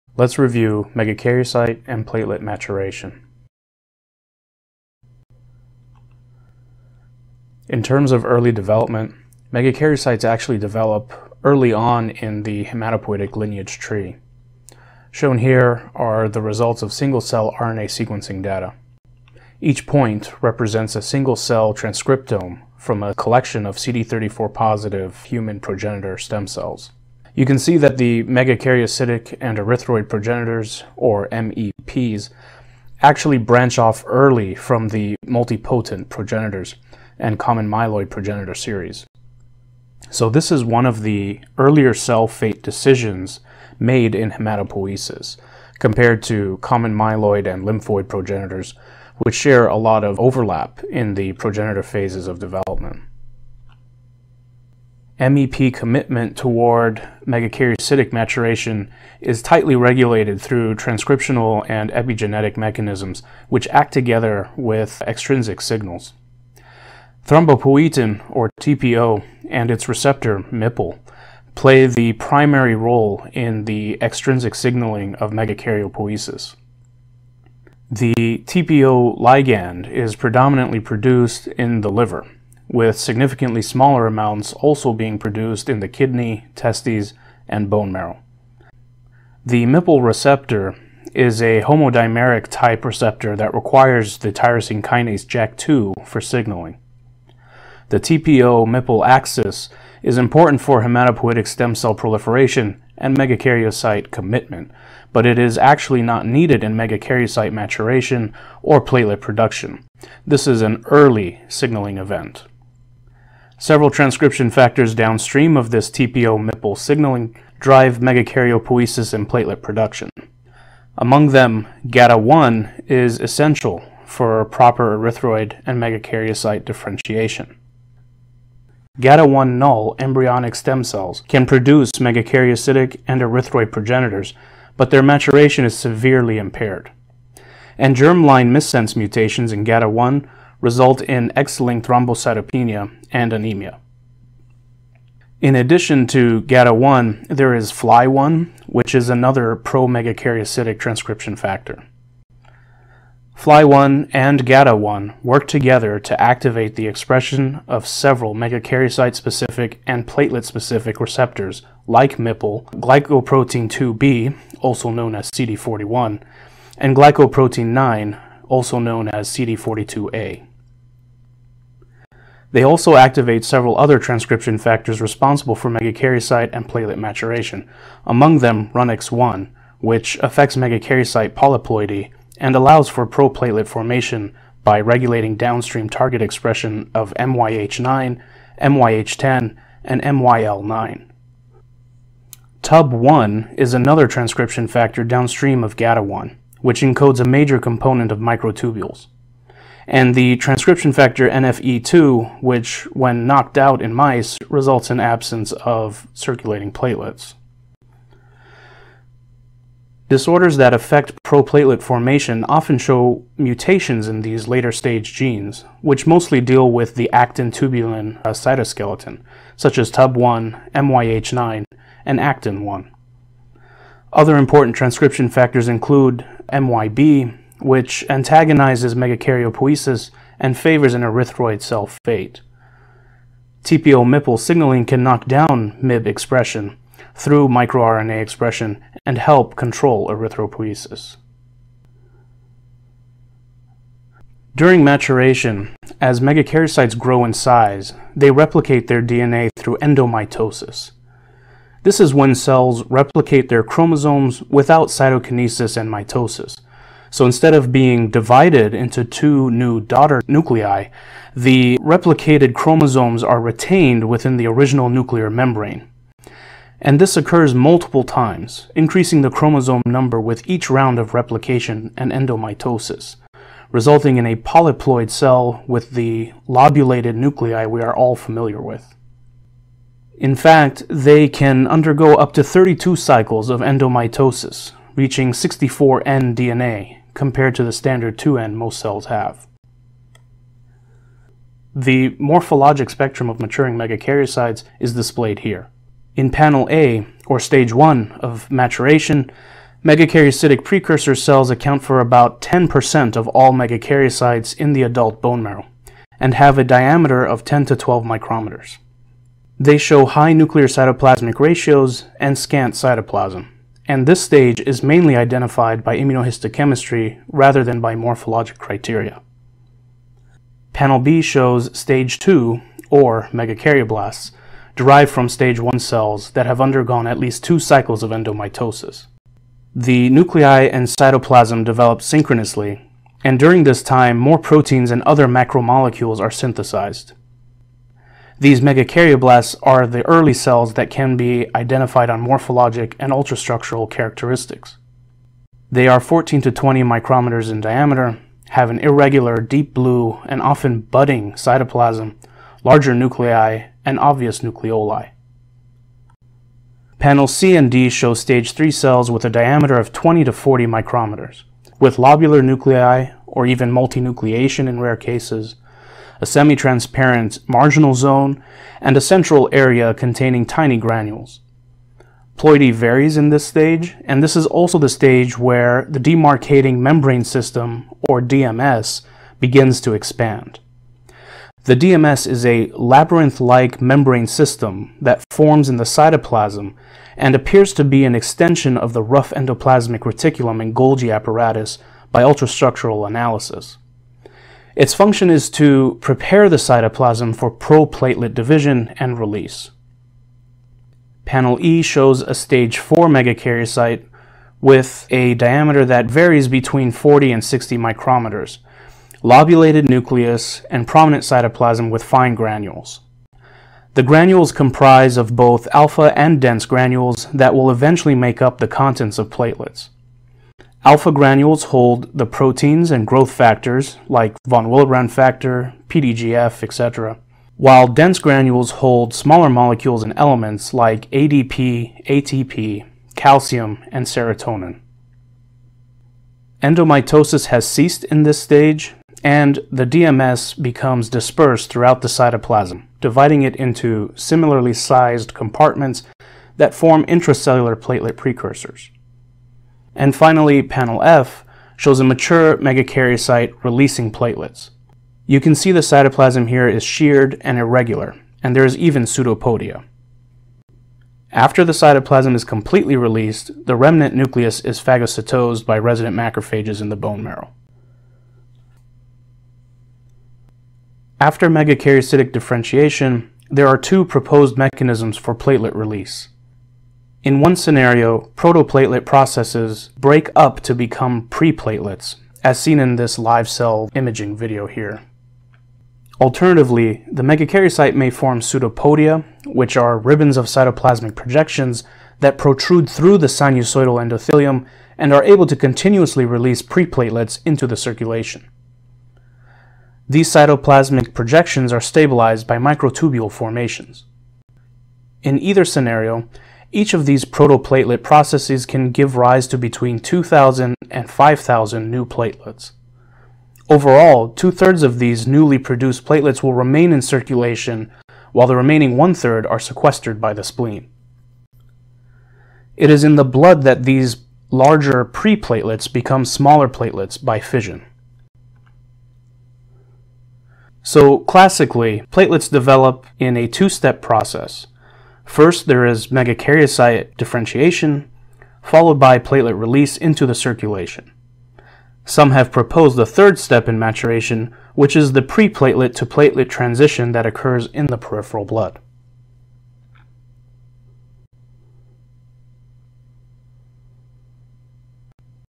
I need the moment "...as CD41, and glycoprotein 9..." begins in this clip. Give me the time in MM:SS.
02:45.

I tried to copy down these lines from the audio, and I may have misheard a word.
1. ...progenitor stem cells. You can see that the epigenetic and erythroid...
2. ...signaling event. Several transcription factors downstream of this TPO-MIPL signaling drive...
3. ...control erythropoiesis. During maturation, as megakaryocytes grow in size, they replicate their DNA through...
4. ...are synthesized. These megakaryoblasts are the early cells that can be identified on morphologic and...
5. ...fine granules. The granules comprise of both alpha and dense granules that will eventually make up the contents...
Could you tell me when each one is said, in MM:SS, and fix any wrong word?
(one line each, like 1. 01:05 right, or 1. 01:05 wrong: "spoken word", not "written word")
1. 00:25 wrong: "megakaryocytic", not "epigenetic"
2. 01:51 right
3. 03:59 right
4. 05:36 right
5. 06:52 right.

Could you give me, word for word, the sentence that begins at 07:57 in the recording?
In one scenario, protoplatelet processes break up to become preplatelets, as seen in this live cell imaging video here.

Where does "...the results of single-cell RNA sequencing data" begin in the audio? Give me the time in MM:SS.
00:16.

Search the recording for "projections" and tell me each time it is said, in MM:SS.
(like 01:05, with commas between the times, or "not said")
08:11, 08:21.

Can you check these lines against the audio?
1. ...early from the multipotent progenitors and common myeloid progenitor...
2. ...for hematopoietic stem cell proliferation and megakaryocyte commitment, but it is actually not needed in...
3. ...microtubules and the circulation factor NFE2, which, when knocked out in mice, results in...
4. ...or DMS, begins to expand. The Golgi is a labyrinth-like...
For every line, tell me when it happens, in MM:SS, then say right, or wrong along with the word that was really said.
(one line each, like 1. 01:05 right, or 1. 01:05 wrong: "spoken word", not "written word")
1. 00:34 right
2. 01:40 right
3. 03:18 wrong: "transcription", not "circulation"
4. 06:18 wrong: "DMS", not "Golgi".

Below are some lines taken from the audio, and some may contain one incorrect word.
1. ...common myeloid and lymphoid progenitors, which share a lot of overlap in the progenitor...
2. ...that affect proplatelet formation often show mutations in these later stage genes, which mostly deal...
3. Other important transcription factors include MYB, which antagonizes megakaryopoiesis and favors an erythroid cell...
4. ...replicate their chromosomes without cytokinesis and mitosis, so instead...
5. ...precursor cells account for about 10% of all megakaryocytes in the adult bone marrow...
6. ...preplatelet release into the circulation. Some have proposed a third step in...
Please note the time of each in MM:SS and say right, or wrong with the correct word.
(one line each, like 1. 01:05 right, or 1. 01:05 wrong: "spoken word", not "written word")
1. 00:46 right
2. 03:30 right
3. 03:44 right
4. 04:12 right
5. 05:00 right
6. 08:59 wrong: "platelet", not "preplatelet".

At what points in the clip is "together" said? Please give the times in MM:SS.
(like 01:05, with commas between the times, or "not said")
01:03, 02:35.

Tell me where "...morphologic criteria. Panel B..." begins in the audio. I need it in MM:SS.
05:17.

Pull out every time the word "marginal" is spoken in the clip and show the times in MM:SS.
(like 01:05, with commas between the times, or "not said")
06:07.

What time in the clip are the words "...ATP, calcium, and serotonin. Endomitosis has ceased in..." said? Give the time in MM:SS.
07:12.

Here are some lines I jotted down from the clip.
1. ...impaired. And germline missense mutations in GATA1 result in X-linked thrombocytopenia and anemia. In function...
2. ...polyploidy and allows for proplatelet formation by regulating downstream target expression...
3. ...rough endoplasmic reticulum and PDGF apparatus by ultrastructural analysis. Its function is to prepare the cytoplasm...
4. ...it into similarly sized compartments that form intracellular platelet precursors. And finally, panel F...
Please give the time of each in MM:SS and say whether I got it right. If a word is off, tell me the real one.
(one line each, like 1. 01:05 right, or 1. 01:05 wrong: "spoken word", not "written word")
1. 02:16 wrong: "addition", not "function"
2. 03:01 right
3. 06:29 wrong: "Golgi", not "PDGF"
4. 07:23 right.